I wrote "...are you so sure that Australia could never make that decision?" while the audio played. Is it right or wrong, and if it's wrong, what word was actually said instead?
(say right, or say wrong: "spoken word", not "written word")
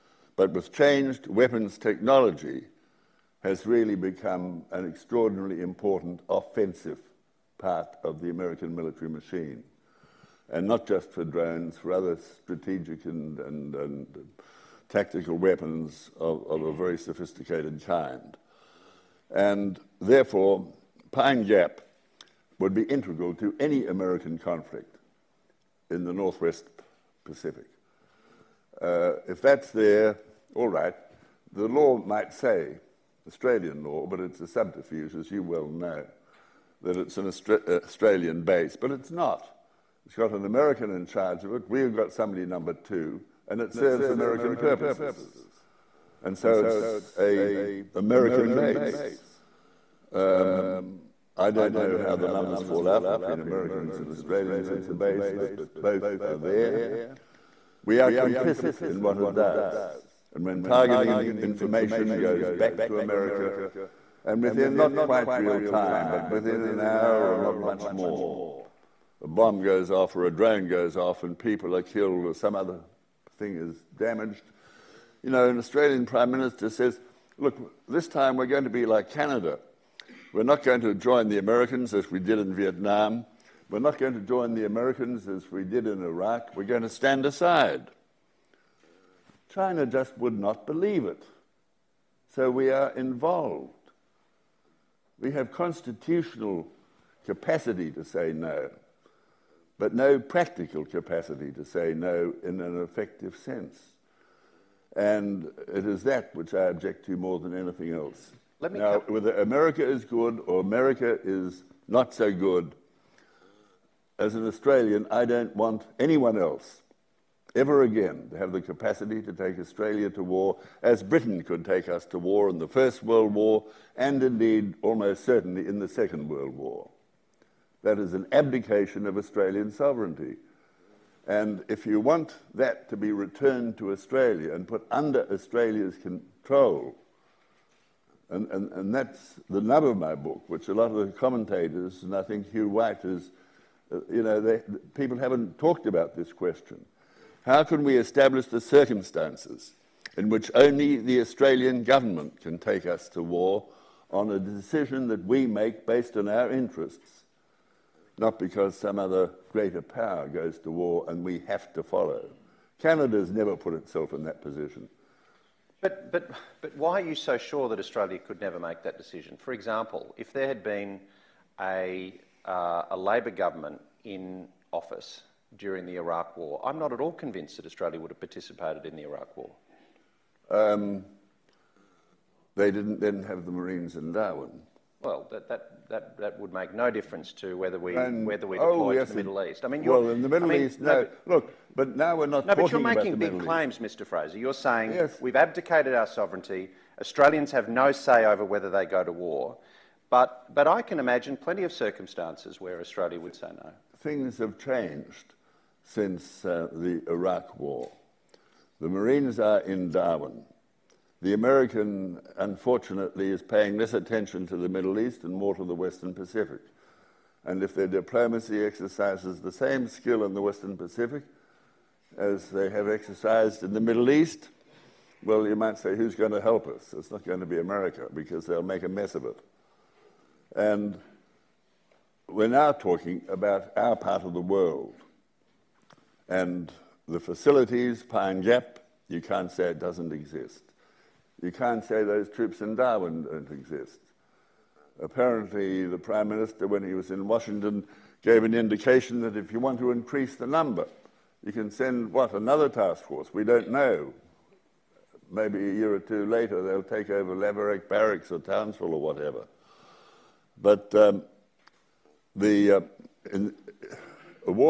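right.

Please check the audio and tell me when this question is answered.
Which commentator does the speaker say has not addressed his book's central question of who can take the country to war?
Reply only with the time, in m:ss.
2:22.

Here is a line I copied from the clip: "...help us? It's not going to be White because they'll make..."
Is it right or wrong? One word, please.
wrong.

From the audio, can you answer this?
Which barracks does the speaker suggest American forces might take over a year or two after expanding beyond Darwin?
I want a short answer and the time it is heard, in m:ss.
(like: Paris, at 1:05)
Lavarack Barracks, at 4:17.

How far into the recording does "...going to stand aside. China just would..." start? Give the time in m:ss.
1:26.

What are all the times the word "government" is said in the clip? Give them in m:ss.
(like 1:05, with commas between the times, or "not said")
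2:31, 2:53.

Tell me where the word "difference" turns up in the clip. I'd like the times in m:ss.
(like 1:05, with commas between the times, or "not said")
3:06.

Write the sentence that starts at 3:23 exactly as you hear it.
Things have changed since uh, the Iraq War.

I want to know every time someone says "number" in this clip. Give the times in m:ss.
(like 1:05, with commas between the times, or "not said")
0:42, 0:52, 4:10.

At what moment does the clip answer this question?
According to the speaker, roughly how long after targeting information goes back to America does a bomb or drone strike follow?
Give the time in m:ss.
1:06.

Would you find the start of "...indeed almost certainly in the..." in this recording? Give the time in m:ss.
2:04.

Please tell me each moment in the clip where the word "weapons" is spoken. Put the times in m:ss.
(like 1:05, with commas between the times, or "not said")
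0:01, 0:15.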